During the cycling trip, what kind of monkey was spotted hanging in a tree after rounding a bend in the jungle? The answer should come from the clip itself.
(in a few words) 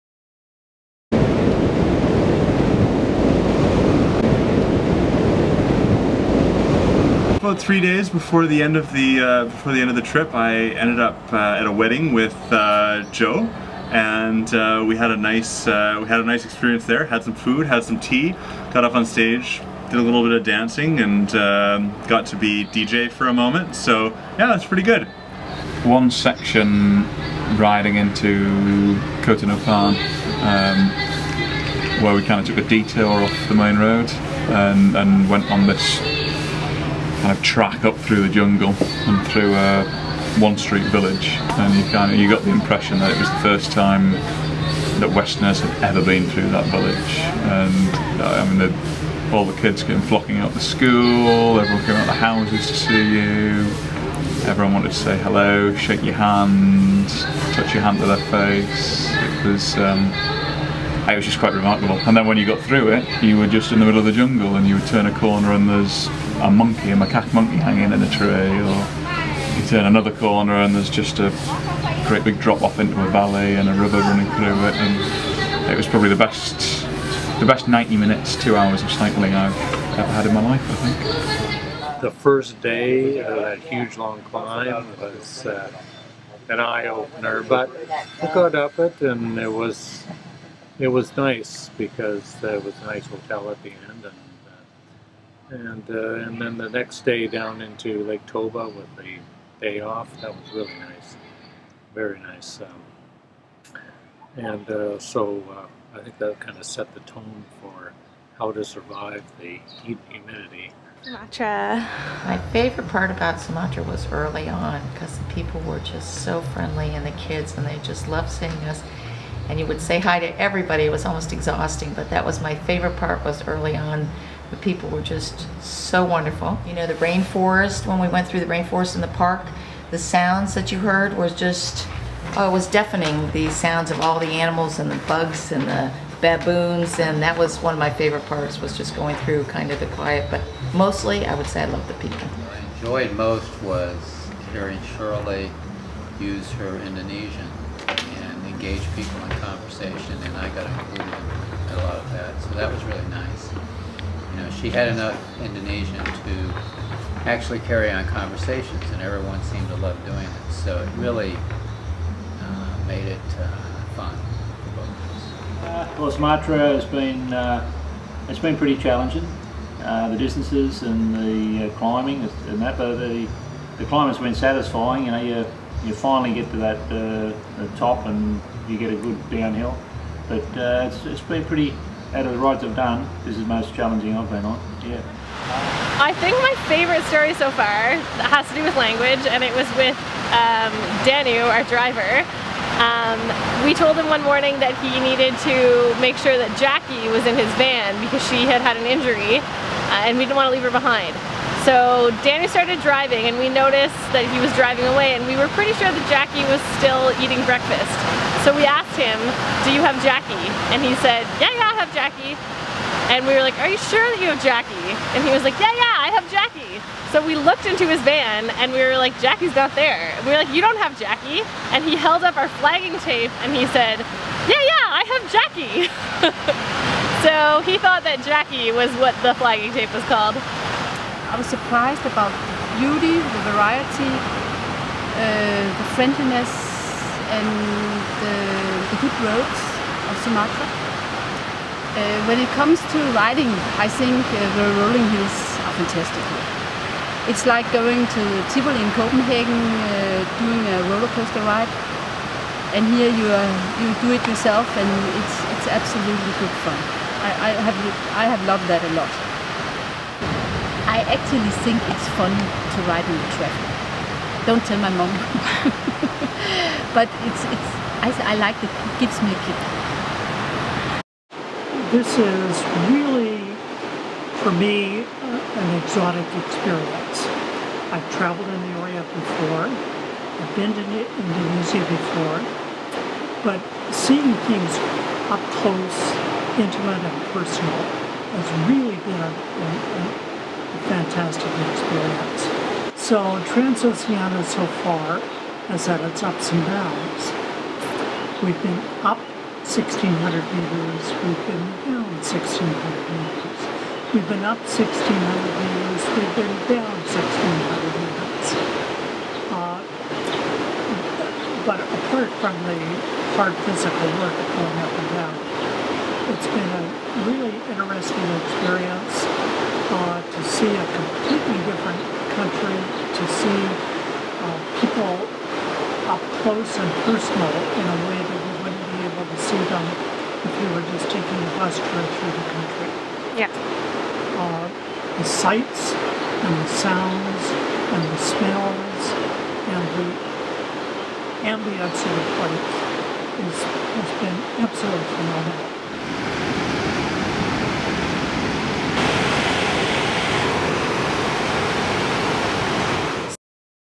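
macaque.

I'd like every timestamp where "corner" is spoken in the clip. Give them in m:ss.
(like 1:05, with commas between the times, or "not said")
1:05, 1:10.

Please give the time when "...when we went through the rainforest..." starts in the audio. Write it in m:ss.
2:07.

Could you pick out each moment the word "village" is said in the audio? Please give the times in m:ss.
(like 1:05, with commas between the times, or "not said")
0:40, 0:46.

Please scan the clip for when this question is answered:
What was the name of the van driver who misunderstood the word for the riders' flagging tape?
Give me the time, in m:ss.
3:11.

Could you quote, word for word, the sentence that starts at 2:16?
And that was one of my favorite parts was just going through kind of the quiet.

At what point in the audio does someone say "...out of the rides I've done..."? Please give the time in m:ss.
3:02.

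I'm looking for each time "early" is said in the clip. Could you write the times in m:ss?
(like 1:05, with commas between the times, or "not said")
1:54, 2:03.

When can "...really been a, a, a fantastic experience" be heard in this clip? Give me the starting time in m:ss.
4:48.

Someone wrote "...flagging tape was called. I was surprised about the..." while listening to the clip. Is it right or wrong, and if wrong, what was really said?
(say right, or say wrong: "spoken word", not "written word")
right.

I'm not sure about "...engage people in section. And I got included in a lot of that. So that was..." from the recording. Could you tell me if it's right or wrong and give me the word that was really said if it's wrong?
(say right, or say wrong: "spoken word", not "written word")
wrong: "conversation", not "section".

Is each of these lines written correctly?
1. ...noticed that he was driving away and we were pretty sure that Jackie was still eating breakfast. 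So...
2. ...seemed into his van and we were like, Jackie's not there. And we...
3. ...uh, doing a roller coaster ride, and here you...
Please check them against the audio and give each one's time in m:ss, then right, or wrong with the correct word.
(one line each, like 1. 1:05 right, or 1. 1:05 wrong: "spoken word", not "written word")
1. 3:23 right
2. 3:37 wrong: "looked", not "seemed"
3. 4:09 right.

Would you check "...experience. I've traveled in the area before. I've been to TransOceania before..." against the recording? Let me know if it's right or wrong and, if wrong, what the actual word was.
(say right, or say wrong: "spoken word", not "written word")
wrong: "Indonesia", not "TransOceania".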